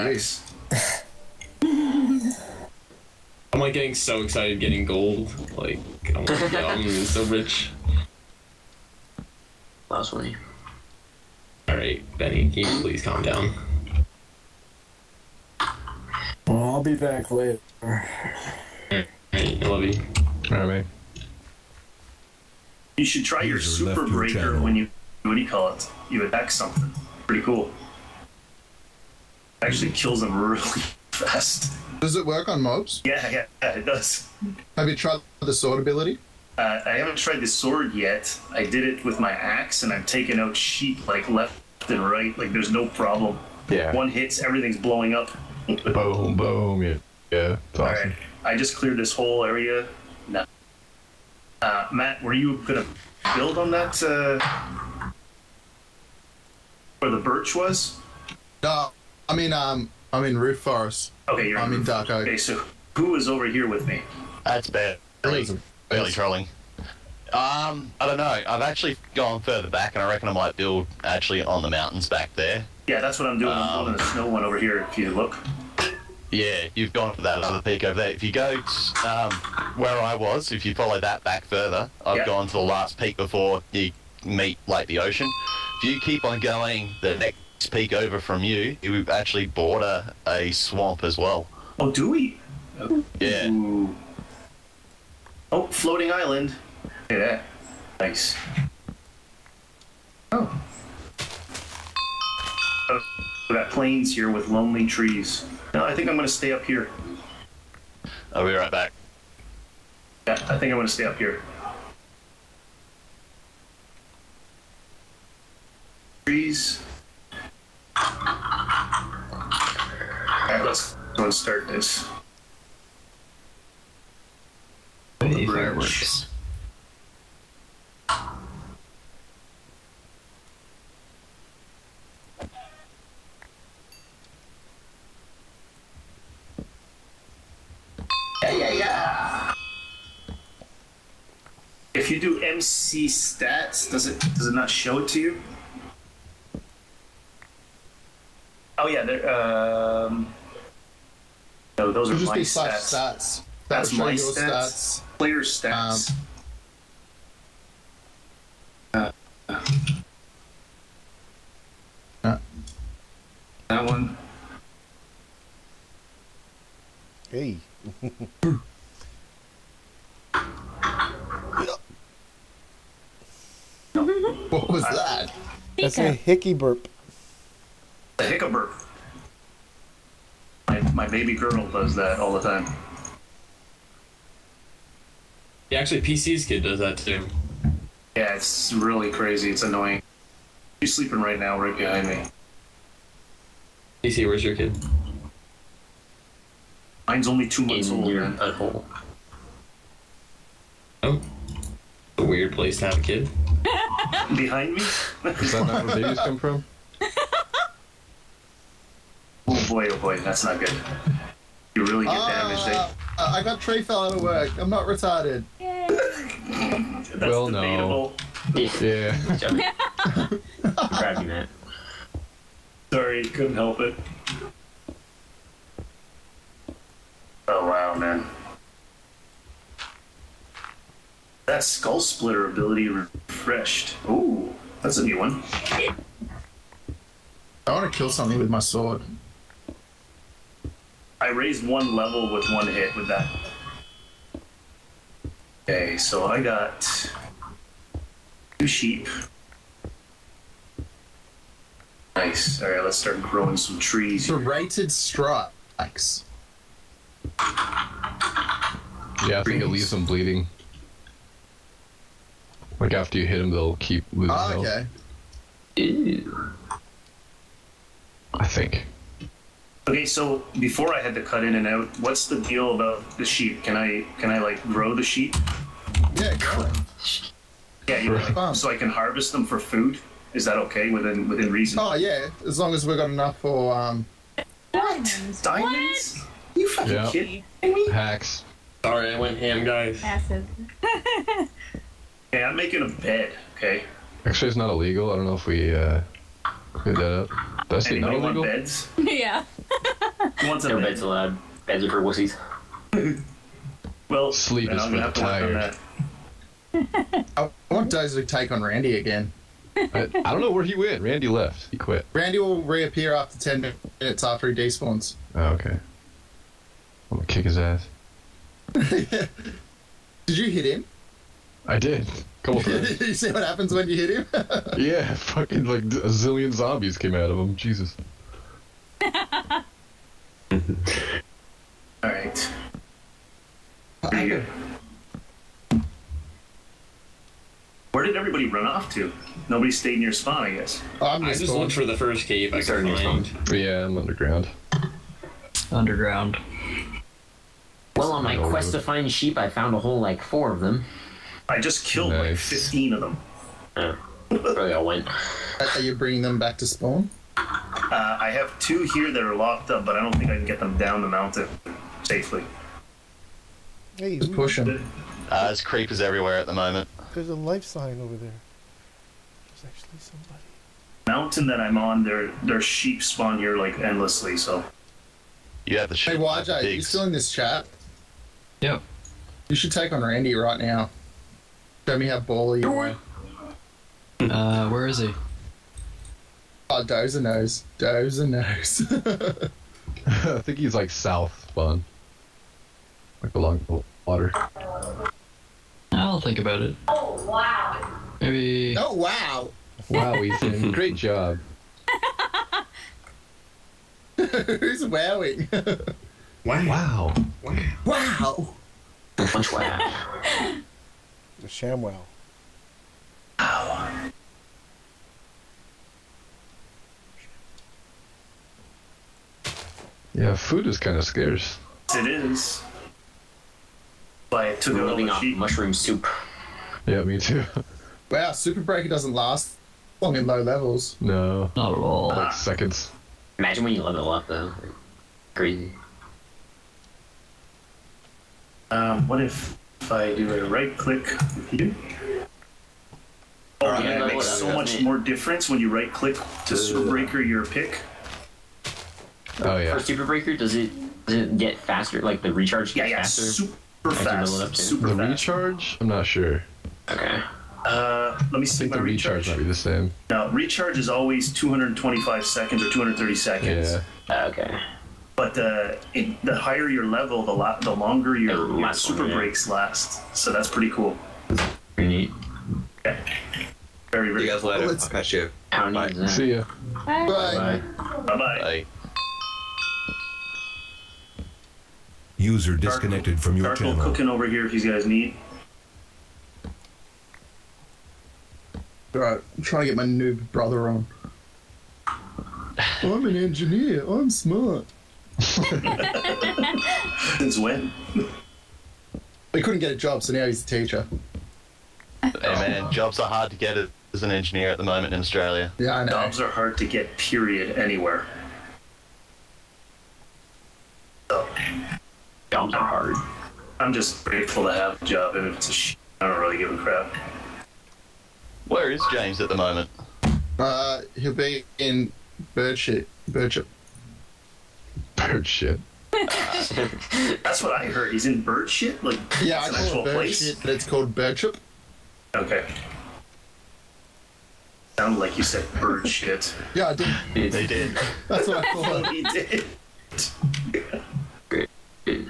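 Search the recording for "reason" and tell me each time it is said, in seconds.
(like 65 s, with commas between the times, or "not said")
281 s.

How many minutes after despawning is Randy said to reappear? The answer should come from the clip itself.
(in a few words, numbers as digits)
10 minutes.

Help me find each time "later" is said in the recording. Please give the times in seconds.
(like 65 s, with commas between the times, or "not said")
17 s, 474 s.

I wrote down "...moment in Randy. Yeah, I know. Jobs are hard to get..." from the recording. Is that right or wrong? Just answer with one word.
wrong.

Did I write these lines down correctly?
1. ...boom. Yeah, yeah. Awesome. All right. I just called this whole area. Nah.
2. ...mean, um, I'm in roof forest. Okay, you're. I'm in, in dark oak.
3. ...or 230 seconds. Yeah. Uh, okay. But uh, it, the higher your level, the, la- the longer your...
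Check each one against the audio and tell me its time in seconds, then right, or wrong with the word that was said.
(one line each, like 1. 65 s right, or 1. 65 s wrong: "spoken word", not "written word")
1. 46 s wrong: "cleared", not "called"
2. 59 s right
3. 462 s right.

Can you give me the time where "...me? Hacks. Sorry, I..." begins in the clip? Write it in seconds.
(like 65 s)
287 s.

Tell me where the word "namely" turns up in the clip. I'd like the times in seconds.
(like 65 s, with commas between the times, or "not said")
not said.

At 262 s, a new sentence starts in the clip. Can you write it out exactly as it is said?
Like after you hit them, they'll keep losing oh, okay.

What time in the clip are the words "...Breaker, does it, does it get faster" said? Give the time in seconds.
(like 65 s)
450 s.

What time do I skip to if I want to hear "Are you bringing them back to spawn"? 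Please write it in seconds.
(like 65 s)
355 s.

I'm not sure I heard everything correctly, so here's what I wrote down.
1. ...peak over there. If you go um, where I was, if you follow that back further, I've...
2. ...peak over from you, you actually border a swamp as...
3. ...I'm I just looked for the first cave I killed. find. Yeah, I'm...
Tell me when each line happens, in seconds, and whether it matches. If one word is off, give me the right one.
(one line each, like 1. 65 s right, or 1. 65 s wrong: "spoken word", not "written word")
1. 77 s right
2. 87 s right
3. 341 s wrong: "started", not "killed".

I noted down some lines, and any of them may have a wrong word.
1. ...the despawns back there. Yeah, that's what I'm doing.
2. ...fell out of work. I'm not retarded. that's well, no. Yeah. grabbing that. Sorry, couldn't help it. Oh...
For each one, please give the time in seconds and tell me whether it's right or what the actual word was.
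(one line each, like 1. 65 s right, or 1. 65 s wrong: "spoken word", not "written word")
1. 71 s wrong: "mountains", not "despawns"
2. 213 s right.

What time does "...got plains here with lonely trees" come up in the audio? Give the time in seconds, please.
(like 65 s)
103 s.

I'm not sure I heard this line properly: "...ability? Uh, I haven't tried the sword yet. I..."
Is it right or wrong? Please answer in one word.
right.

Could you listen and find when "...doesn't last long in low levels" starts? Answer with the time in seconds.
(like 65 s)
428 s.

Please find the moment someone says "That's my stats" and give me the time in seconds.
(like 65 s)
153 s.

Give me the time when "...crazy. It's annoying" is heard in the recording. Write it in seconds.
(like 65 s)
189 s.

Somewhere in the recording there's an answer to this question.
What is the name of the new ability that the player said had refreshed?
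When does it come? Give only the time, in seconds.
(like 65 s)
231 s.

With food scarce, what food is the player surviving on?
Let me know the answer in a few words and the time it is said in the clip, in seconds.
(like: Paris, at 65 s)
Mushroom soup, at 425 s.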